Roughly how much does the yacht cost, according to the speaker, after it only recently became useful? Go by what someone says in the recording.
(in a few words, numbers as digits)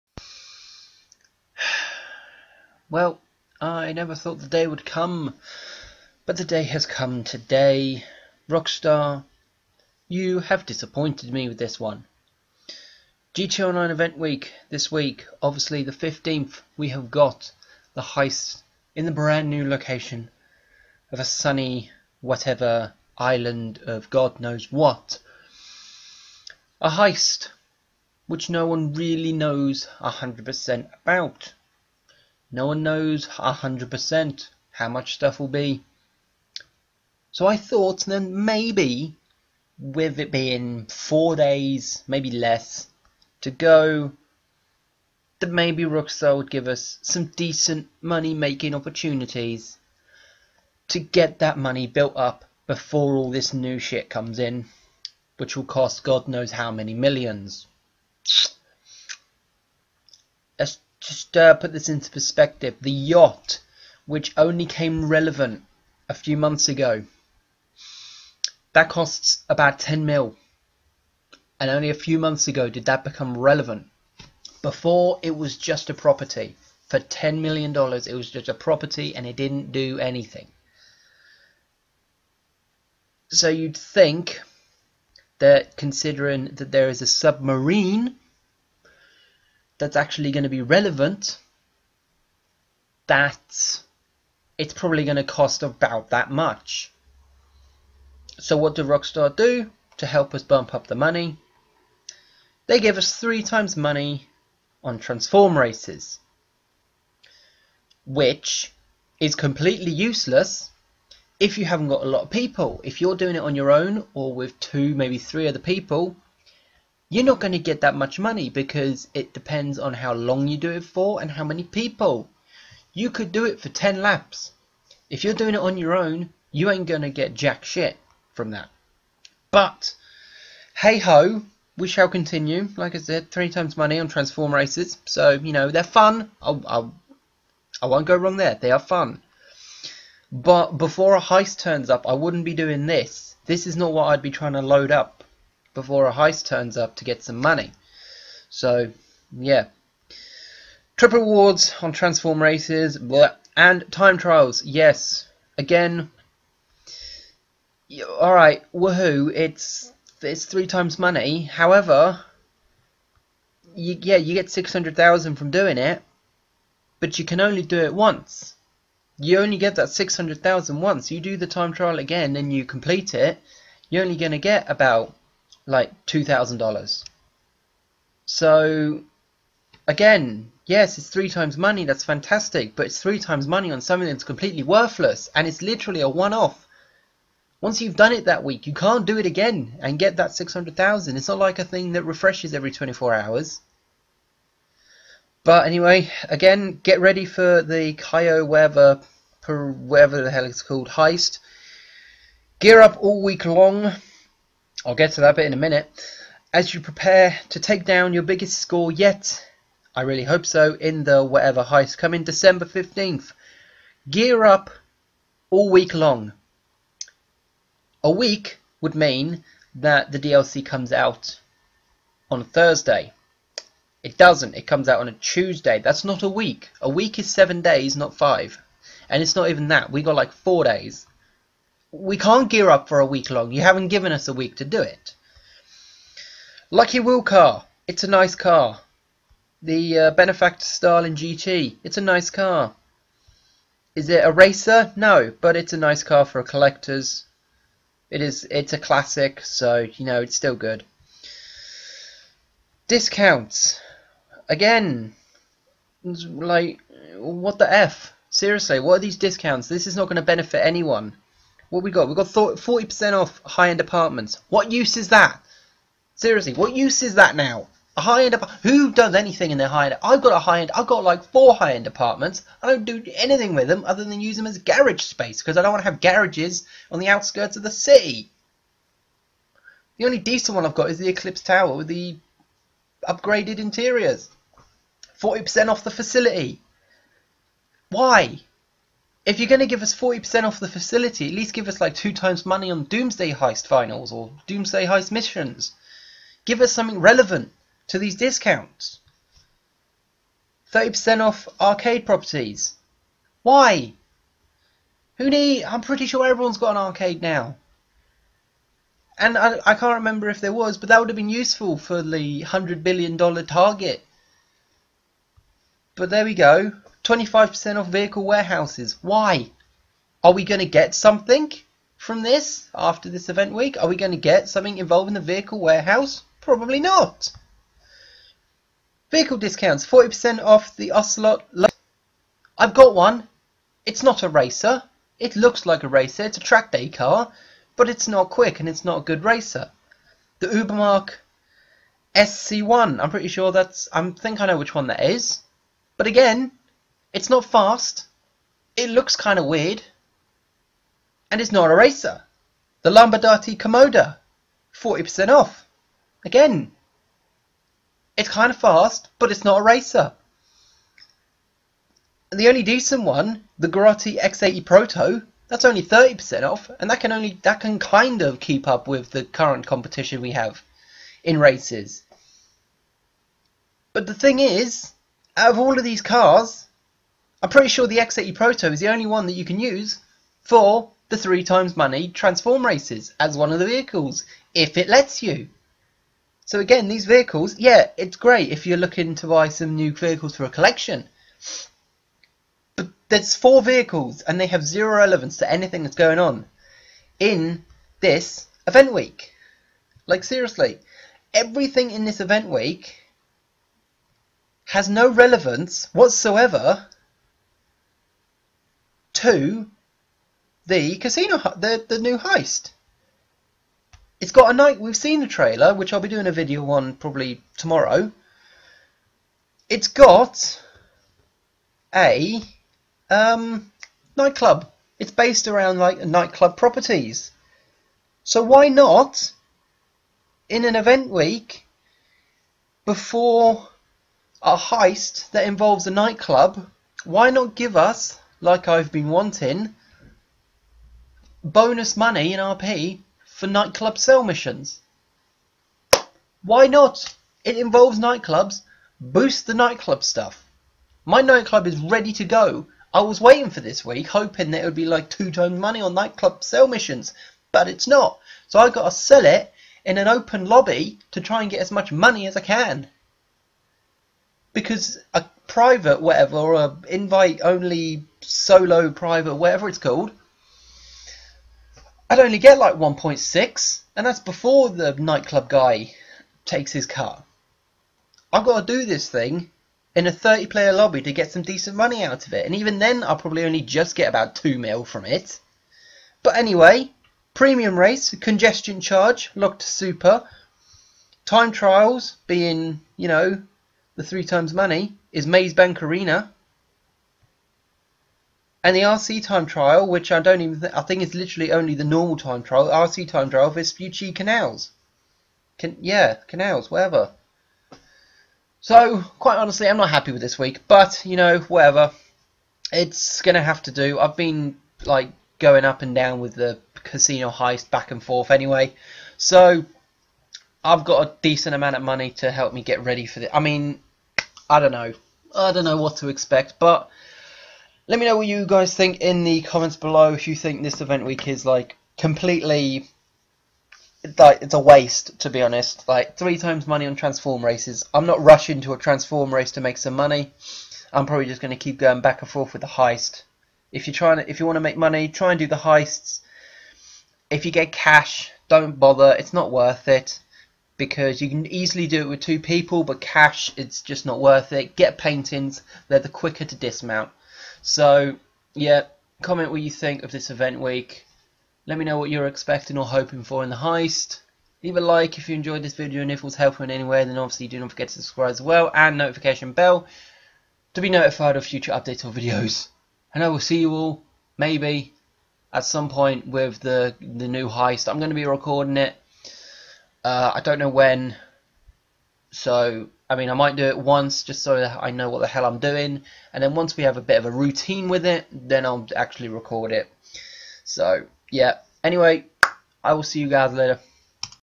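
10 mil.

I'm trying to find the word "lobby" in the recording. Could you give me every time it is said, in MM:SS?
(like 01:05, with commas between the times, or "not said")
07:40, 08:00.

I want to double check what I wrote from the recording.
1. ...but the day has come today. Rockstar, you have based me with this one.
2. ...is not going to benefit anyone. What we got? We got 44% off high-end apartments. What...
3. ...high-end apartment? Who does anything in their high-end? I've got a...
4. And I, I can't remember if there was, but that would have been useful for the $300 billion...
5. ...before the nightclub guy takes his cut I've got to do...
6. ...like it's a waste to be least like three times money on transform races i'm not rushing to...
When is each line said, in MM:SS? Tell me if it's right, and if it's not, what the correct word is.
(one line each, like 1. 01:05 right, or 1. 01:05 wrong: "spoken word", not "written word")
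1. 00:06 wrong: "disappointed", not "based"
2. 04:19 wrong: "40", not "44"
3. 04:28 right
4. 05:09 wrong: "100", not "300"
5. 07:54 right
6. 08:54 wrong: "honest", not "least".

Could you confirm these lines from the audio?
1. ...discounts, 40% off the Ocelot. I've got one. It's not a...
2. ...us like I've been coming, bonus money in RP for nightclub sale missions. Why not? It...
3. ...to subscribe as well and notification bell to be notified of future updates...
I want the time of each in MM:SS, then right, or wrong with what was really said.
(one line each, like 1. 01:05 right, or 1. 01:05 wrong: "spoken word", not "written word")
1. 05:29 right
2. 07:17 wrong: "wanting", not "coming"
3. 09:27 right.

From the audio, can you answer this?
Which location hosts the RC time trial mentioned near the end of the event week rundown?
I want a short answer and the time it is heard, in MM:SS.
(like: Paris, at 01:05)
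Vespucci Canals, at 08:23.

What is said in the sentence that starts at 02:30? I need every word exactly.
Trip rewards on transform races and time trials.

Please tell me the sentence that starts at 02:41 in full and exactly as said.
However, you, yeah, you get six hundred thousand from doing it, but you can only do it once.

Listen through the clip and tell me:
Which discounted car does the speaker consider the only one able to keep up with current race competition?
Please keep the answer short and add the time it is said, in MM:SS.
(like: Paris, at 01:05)
Grotti X80 Proto, at 06:03.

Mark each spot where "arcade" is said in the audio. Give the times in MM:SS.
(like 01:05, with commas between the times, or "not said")
05:01, 05:06.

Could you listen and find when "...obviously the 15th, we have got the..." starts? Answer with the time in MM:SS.
00:15.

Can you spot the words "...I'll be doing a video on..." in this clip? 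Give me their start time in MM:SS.
06:55.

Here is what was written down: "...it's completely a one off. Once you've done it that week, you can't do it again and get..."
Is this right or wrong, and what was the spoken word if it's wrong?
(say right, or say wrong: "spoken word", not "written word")
wrong: "literally", not "completely".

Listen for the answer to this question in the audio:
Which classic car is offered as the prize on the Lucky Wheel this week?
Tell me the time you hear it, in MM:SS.
04:00.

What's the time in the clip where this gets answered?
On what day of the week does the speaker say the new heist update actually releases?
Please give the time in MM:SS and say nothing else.
03:45.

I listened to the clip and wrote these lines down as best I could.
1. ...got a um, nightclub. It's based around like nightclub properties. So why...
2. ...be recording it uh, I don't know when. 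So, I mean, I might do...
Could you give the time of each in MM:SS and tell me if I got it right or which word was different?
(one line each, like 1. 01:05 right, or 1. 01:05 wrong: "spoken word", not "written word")
1. 06:59 right
2. 09:38 right.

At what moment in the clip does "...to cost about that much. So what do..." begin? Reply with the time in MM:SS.
01:35.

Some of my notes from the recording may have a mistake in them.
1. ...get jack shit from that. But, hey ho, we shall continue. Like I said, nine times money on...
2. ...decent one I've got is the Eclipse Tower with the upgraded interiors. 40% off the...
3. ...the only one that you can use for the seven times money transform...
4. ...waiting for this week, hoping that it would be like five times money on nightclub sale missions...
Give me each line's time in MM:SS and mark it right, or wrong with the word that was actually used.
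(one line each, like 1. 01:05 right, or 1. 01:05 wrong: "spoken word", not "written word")
1. 02:07 wrong: "three", not "nine"
2. 04:40 right
3. 06:18 wrong: "three", not "seven"
4. 07:33 wrong: "two", not "five".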